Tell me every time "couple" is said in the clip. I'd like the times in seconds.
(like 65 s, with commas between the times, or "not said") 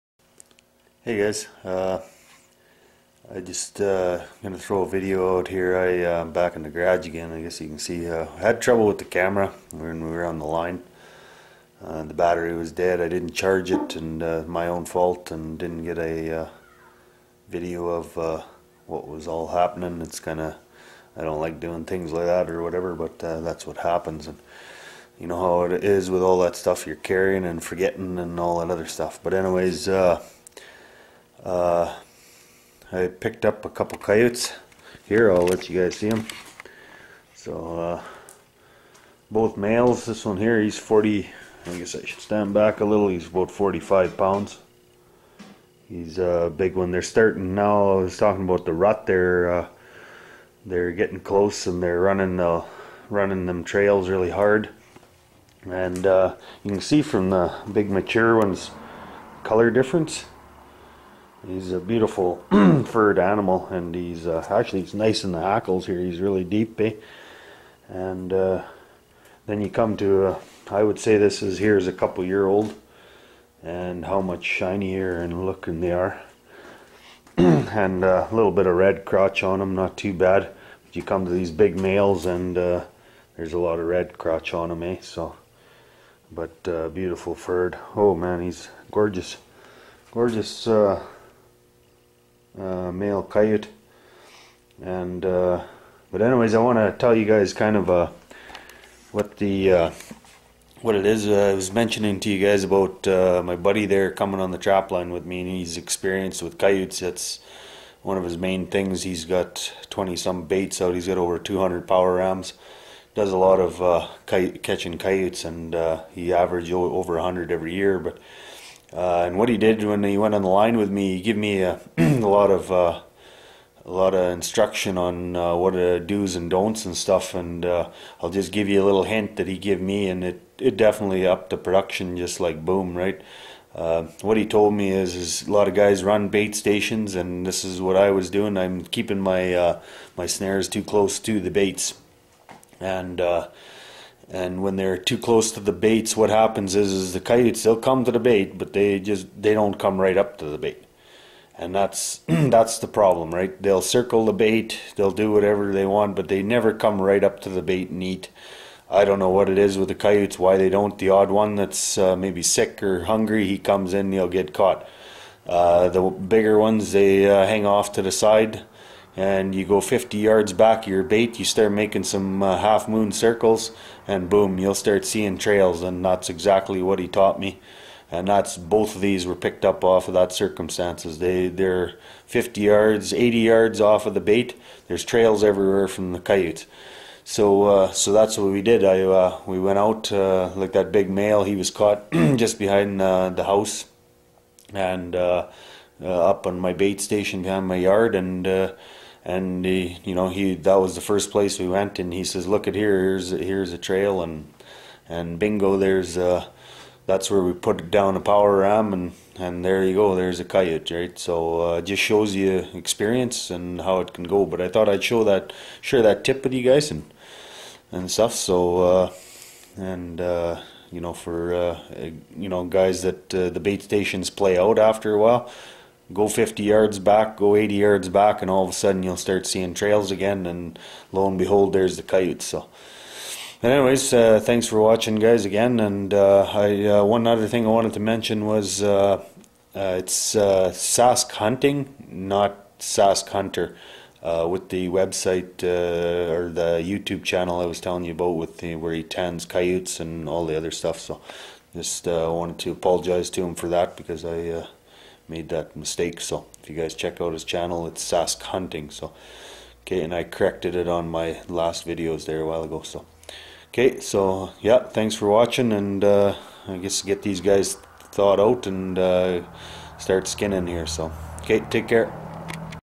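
33 s, 71 s.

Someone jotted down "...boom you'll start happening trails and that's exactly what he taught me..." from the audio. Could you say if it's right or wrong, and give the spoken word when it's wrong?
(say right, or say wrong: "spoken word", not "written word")
wrong: "seeing", not "happening".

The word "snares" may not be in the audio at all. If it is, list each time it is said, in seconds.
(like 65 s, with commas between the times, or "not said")
140 s.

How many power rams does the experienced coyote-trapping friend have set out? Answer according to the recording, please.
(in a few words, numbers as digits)
over 200.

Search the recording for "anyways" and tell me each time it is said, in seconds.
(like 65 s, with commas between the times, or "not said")
29 s, 96 s, 233 s.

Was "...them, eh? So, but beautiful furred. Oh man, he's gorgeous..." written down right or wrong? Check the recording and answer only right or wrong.
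right.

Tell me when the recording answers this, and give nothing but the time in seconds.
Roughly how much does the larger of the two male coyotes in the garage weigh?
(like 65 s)
43 s.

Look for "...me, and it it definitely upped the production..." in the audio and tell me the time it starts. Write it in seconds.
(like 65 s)
129 s.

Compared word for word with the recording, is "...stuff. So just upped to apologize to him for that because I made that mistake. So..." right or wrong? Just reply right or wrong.
wrong.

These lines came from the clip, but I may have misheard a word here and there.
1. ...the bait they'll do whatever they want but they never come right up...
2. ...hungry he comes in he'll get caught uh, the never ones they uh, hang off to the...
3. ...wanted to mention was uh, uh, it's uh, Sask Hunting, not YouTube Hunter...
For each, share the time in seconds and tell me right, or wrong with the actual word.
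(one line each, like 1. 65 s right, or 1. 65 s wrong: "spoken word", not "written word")
1. 154 s right
2. 163 s wrong: "bigger", not "never"
3. 237 s wrong: "Sask", not "YouTube".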